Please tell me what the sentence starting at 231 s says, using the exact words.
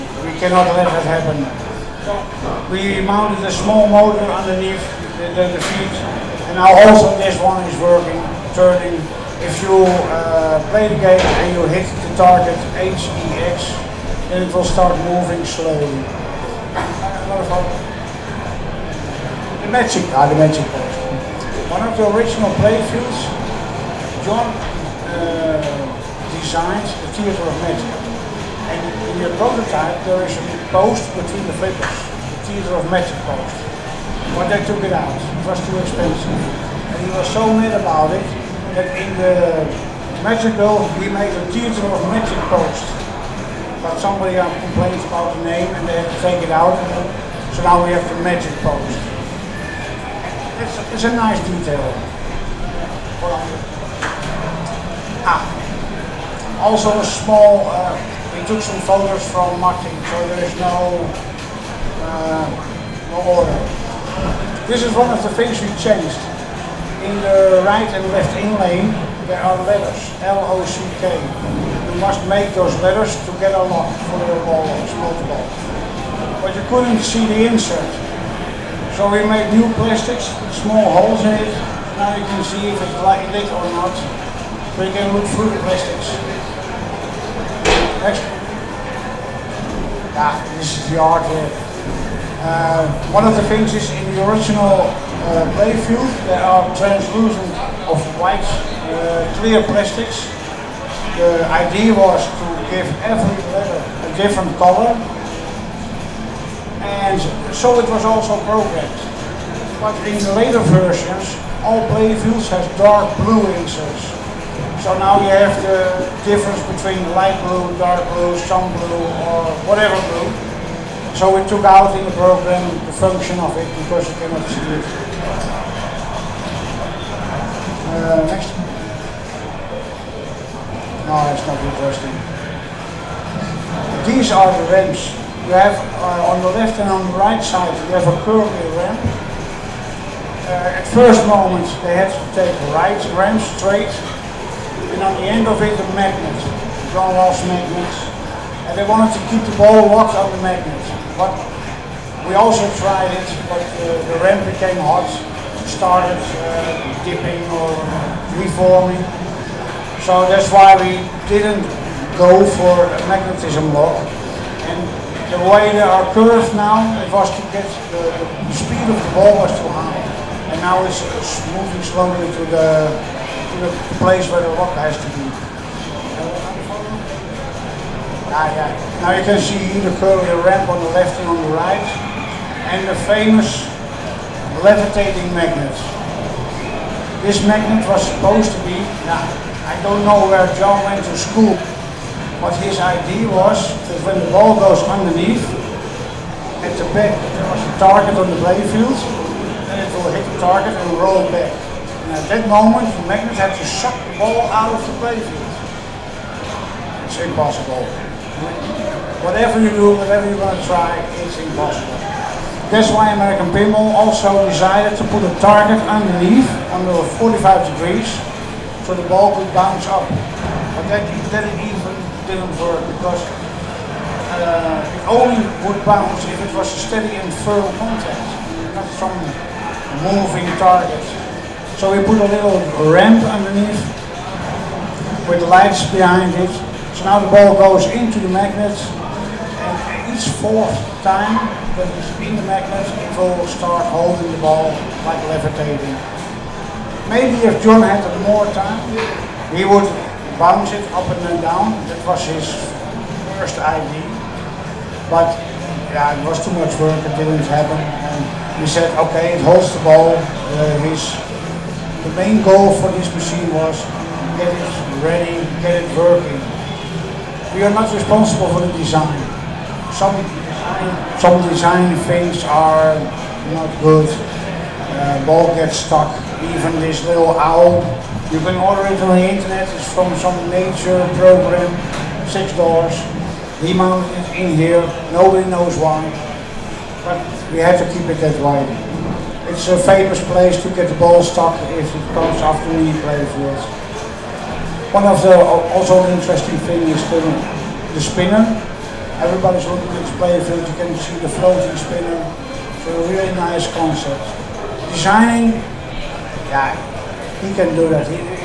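So we put a little ramp underneath with lights behind it.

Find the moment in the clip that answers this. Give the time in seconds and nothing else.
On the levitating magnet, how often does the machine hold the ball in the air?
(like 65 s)
240 s.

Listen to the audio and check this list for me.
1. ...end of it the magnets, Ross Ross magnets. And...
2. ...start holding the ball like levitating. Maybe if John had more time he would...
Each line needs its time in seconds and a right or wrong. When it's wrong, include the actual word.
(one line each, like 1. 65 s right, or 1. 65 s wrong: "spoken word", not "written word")
1. 145 s wrong: "John", not "Ross"
2. 243 s right.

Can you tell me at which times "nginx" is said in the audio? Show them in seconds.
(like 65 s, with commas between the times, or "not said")
not said.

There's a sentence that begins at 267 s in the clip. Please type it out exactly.
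We are not responsible for the design.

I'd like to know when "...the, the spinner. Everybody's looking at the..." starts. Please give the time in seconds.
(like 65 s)
297 s.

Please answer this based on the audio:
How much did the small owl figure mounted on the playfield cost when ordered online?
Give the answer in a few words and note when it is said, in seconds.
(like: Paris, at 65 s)
6 dollars, at 282 s.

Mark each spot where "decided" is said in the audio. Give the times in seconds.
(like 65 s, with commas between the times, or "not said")
214 s.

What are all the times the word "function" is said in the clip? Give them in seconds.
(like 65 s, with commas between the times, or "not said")
122 s.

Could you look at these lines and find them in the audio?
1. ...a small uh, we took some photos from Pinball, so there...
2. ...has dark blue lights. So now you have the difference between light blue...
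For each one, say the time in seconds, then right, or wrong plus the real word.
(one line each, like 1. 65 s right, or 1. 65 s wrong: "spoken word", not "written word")
1. 56 s wrong: "Martin", not "Pinball"
2. 112 s wrong: "inserts", not "lights".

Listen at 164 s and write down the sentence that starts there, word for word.
And the way they are curved now, it was to get the, uh, the speed of the ball was too high.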